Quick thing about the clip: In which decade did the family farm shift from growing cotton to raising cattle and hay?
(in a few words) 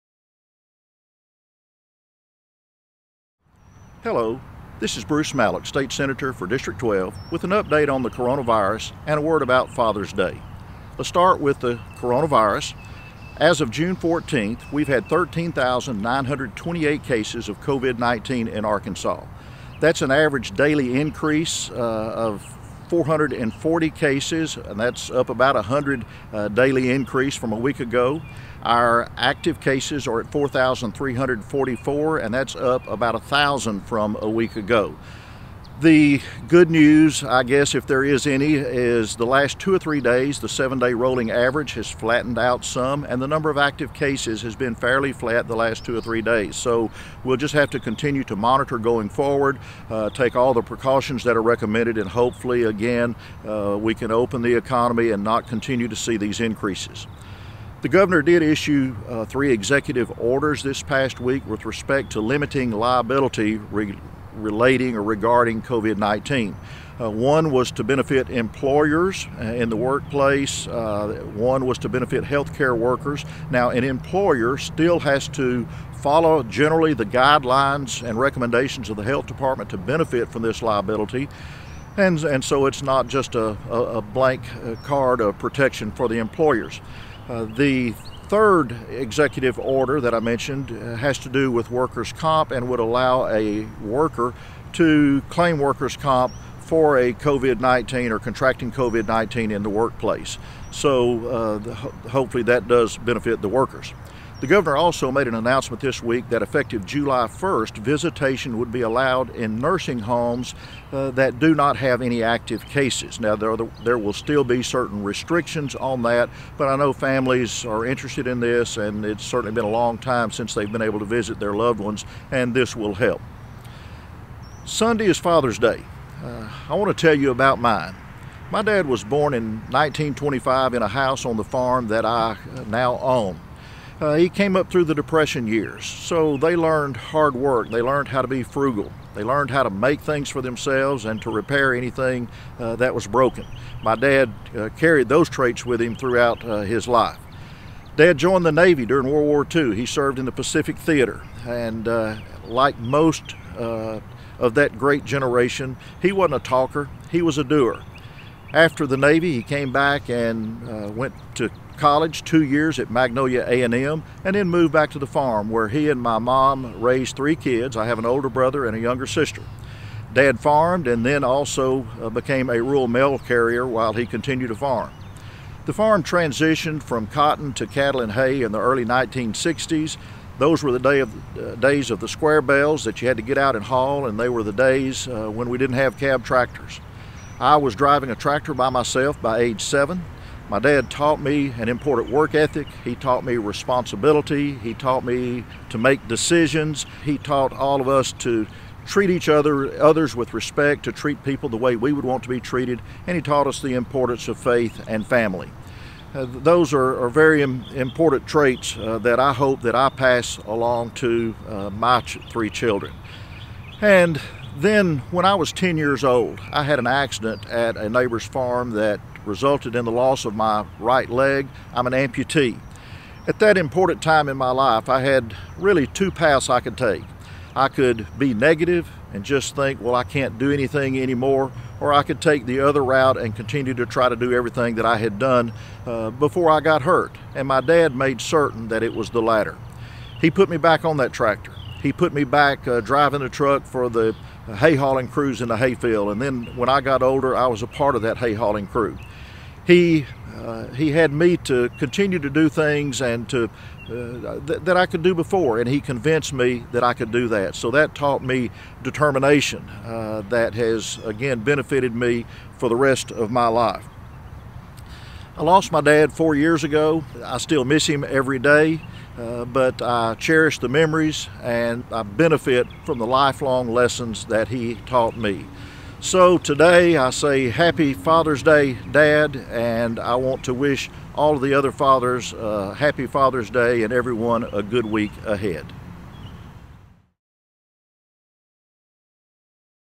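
early 1960s.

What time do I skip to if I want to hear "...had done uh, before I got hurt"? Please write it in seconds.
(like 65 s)
234 s.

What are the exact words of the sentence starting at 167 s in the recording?
I have an older brother and a younger sister.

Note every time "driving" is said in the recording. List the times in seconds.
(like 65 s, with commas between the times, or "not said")
187 s, 242 s.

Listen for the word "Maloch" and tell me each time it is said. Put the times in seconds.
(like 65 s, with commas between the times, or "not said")
5 s.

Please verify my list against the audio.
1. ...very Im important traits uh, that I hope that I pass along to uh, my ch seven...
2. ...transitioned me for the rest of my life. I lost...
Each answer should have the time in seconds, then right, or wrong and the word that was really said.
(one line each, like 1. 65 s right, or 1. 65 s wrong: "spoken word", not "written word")
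1. 207 s wrong: "three", not "seven"
2. 261 s wrong: "benefited", not "transitioned".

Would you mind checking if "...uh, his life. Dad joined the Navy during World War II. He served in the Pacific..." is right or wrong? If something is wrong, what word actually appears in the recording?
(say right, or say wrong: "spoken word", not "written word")
right.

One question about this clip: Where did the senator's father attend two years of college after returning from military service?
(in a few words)
Magnolia A&M.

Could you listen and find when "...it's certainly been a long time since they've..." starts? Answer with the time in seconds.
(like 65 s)
119 s.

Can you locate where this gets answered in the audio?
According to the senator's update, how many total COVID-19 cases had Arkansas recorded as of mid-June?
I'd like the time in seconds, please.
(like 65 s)
15 s.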